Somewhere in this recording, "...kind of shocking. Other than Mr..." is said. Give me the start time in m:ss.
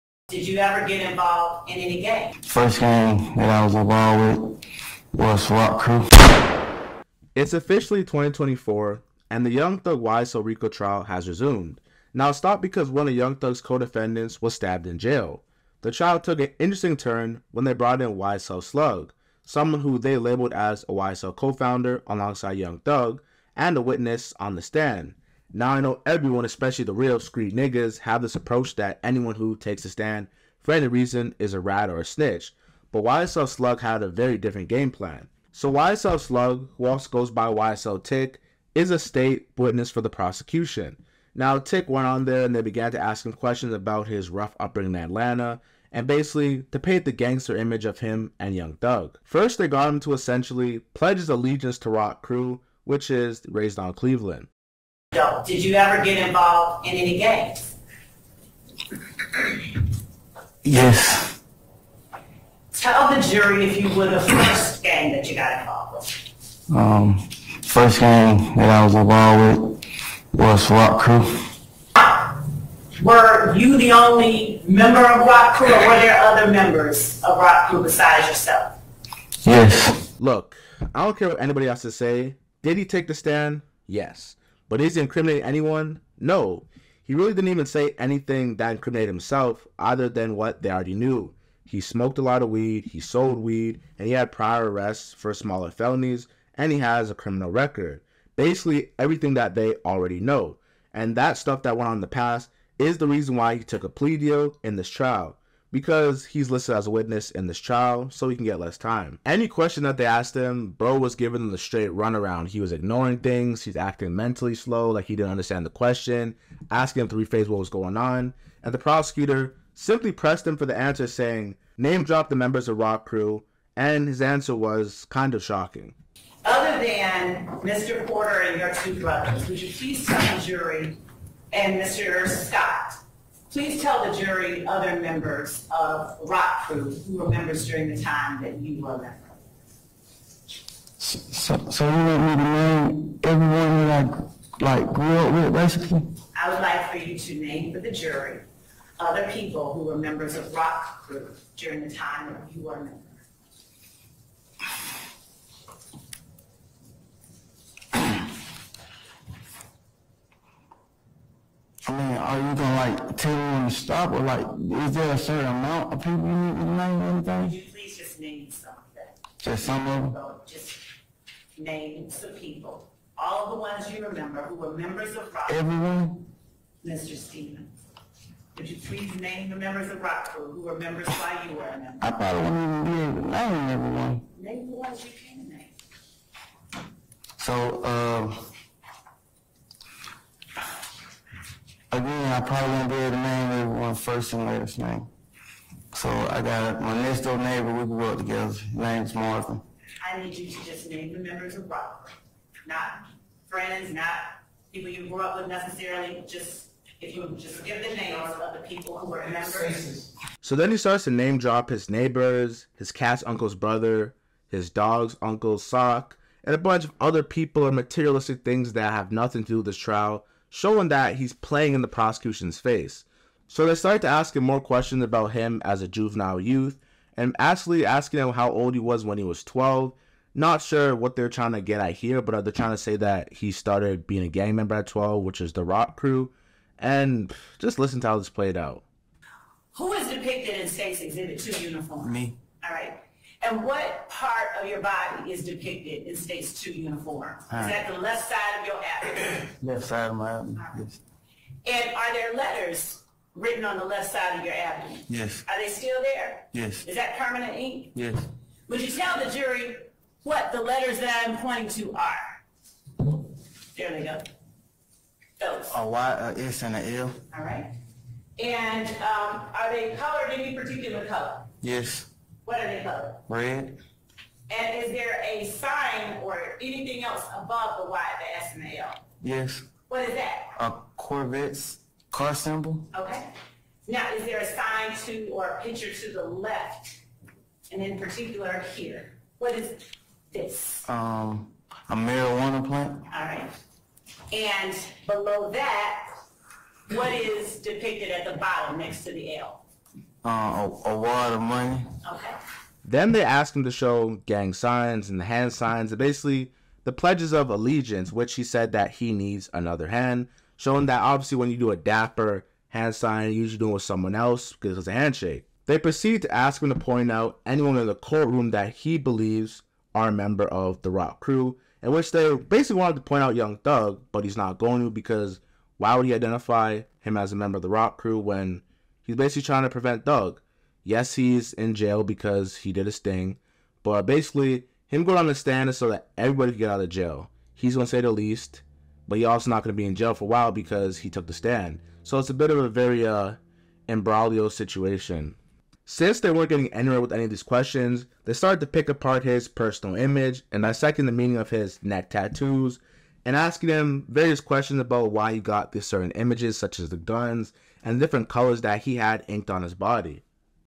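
2:05.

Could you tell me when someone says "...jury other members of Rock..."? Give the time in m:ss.
2:14.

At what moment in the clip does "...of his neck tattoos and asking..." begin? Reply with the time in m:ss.
5:51.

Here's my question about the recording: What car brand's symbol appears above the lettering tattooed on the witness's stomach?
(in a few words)
Corvette.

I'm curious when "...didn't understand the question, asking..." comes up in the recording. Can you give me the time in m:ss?
1:55.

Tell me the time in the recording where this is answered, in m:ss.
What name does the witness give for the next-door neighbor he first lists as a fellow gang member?
3:19.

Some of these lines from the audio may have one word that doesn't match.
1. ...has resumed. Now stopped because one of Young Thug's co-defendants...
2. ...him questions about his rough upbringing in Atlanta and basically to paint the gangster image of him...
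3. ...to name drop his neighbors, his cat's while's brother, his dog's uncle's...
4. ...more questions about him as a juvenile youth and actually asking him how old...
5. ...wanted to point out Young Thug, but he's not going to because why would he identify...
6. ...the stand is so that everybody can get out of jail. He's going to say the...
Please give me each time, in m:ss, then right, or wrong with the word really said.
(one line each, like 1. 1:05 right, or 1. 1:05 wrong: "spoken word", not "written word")
1. 0:11 right
2. 0:43 right
3. 3:31 wrong: "uncle", not "while"
4. 3:44 right
5. 5:22 right
6. 5:35 right.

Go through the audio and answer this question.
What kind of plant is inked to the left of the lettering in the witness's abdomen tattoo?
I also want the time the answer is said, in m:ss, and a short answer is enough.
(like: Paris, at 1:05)
Marijuana plant, at 4:51.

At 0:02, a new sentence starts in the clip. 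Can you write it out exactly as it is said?
First game that I was involved with was Rock Crew.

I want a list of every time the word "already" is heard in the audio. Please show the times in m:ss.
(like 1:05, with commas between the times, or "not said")
1:30, 1:39.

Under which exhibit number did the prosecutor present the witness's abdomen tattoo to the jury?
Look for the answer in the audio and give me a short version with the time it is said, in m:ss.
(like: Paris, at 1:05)
2, at 4:01.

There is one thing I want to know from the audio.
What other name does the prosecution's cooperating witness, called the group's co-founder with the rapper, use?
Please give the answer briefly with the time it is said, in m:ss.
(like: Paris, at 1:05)
YSL Tick, at 0:37.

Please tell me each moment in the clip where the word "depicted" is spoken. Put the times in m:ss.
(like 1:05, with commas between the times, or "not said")
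4:00, 4:05, 4:57.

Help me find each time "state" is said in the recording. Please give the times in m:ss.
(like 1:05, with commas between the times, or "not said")
0:38, 4:00, 4:06.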